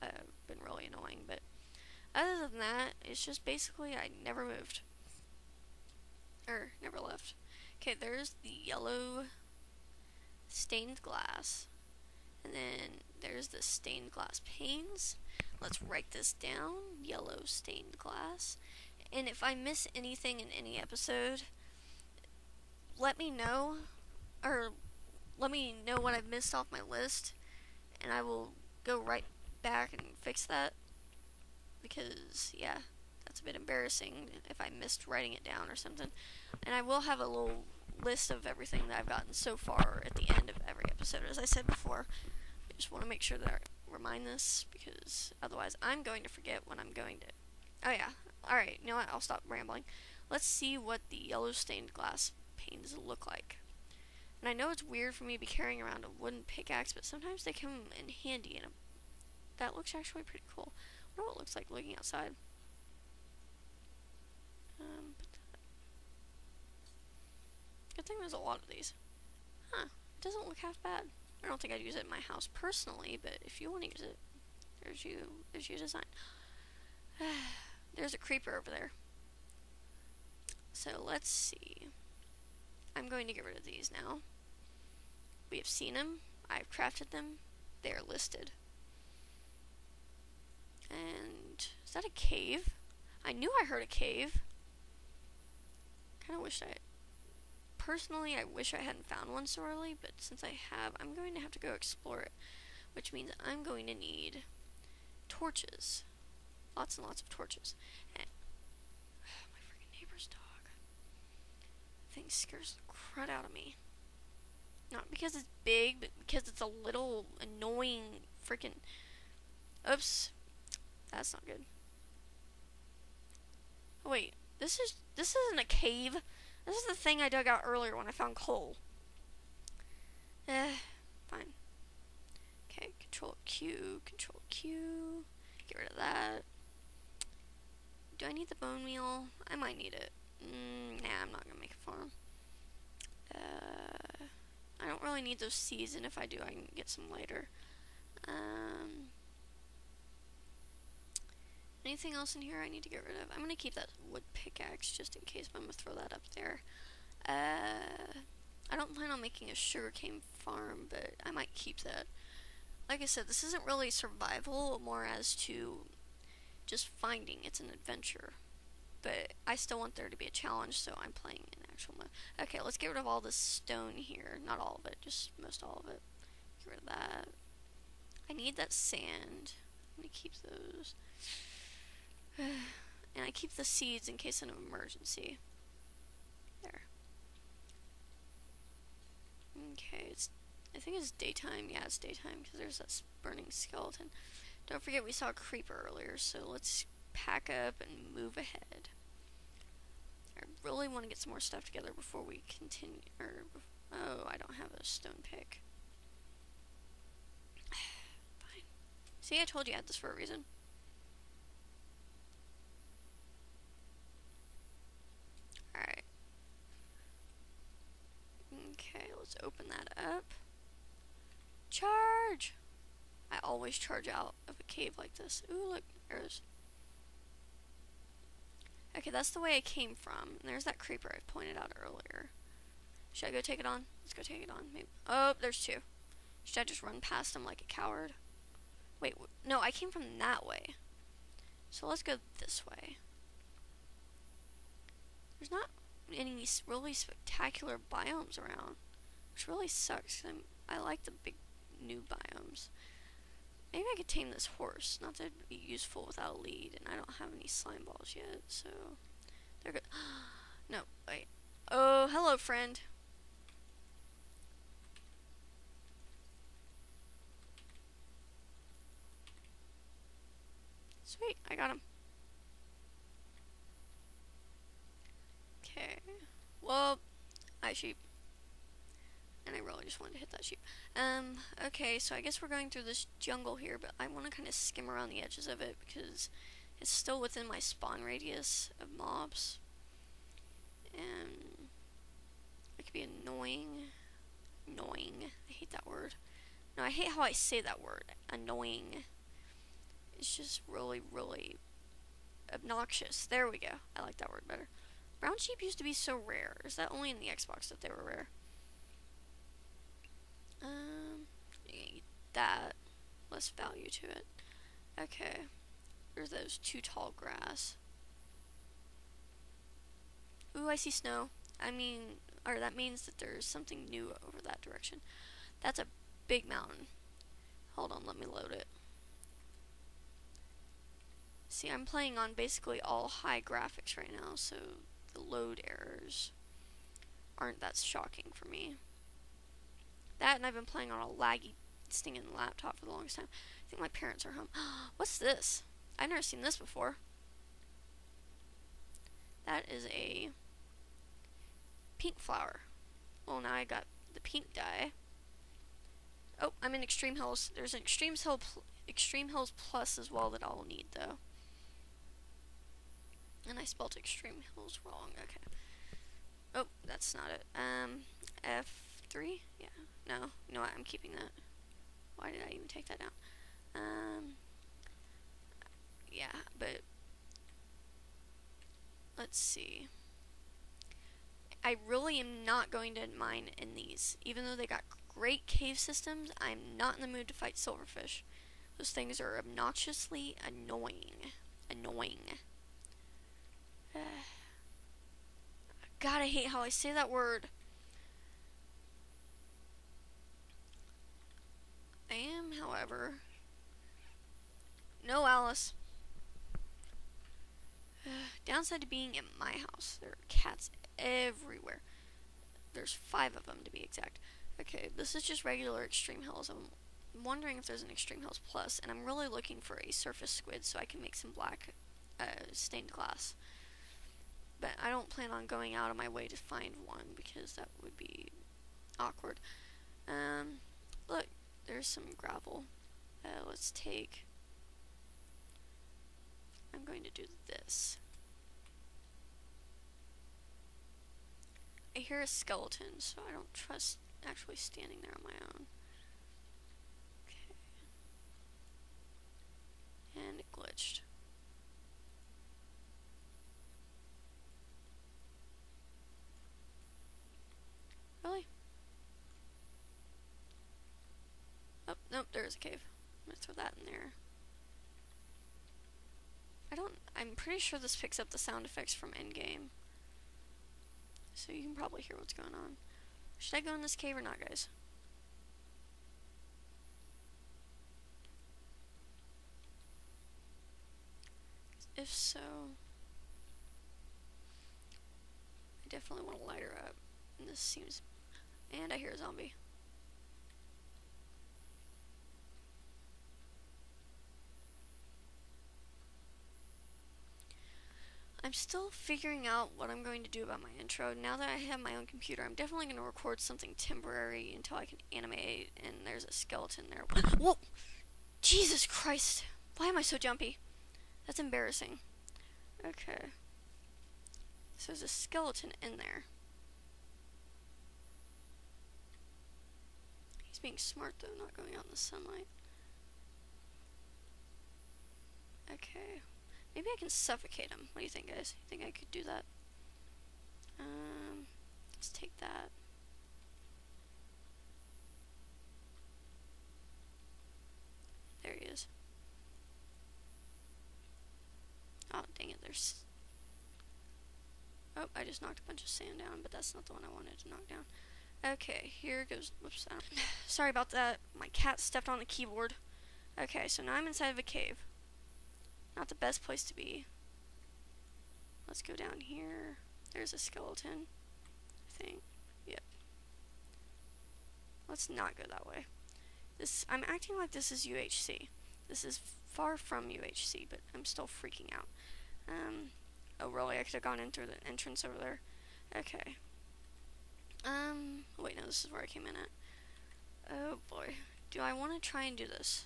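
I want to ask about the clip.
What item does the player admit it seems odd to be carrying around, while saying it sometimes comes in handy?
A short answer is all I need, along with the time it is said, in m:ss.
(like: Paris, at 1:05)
Wooden pickaxe, at 0:56.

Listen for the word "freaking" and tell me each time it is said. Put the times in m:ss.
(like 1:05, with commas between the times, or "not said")
1:49, 1:58, 9:31.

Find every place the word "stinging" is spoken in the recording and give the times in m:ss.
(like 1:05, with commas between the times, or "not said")
5:41.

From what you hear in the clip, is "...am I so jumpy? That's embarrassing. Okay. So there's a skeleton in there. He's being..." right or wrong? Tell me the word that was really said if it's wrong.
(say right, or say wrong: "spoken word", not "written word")
right.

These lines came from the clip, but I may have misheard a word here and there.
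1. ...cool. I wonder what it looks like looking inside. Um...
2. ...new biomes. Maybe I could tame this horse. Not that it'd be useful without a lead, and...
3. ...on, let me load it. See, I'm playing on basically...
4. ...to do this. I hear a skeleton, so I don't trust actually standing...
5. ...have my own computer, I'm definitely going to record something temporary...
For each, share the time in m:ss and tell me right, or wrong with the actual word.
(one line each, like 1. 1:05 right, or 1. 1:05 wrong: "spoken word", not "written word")
1. 1:00 wrong: "outside", not "inside"
2. 4:11 right
3. 5:27 right
4. 7:17 right
5. 8:21 right.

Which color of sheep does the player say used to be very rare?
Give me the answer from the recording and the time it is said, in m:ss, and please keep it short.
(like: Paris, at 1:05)
Brown, at 5:05.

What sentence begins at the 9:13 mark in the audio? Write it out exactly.
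Okay, so now I'm inside of a cave.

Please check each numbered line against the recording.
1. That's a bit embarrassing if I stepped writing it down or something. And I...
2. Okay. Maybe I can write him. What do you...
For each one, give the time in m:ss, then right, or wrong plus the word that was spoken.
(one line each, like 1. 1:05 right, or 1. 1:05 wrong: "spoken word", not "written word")
1. 0:33 wrong: "missed", not "stepped"
2. 8:45 wrong: "suffocate", not "write".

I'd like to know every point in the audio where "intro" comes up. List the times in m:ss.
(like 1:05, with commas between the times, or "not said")
8:20.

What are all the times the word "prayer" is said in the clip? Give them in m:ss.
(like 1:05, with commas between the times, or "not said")
not said.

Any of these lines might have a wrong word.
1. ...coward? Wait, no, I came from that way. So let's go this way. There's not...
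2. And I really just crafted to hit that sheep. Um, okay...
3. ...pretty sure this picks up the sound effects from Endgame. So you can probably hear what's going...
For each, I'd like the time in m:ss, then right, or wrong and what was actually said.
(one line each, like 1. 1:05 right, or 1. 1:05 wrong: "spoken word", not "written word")
1. 3:57 right
2. 4:39 wrong: "wanted", not "crafted"
3. 7:47 right.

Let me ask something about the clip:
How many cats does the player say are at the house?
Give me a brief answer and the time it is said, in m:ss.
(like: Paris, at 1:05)
5, at 6:52.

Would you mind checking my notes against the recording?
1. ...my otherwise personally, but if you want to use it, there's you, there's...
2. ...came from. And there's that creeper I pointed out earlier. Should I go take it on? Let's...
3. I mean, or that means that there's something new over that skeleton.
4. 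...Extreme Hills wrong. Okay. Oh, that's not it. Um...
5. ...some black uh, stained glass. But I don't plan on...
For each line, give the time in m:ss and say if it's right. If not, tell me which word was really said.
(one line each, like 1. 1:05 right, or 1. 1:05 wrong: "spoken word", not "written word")
1. 1:12 wrong: "house", not "otherwise"
2. 3:49 right
3. 5:21 wrong: "direction", not "skeleton"
4. 6:03 right
5. 7:01 right.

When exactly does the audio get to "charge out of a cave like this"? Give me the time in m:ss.
3:43.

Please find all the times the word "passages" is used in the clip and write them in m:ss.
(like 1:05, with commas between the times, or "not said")
not said.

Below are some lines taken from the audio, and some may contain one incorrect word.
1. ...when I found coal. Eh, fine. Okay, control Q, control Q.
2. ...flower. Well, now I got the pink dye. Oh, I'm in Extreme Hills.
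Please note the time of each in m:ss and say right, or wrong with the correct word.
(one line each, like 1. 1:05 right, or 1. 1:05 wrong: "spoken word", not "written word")
1. 2:07 right
2. 5:52 right.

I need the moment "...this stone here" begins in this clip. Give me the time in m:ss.
2:53.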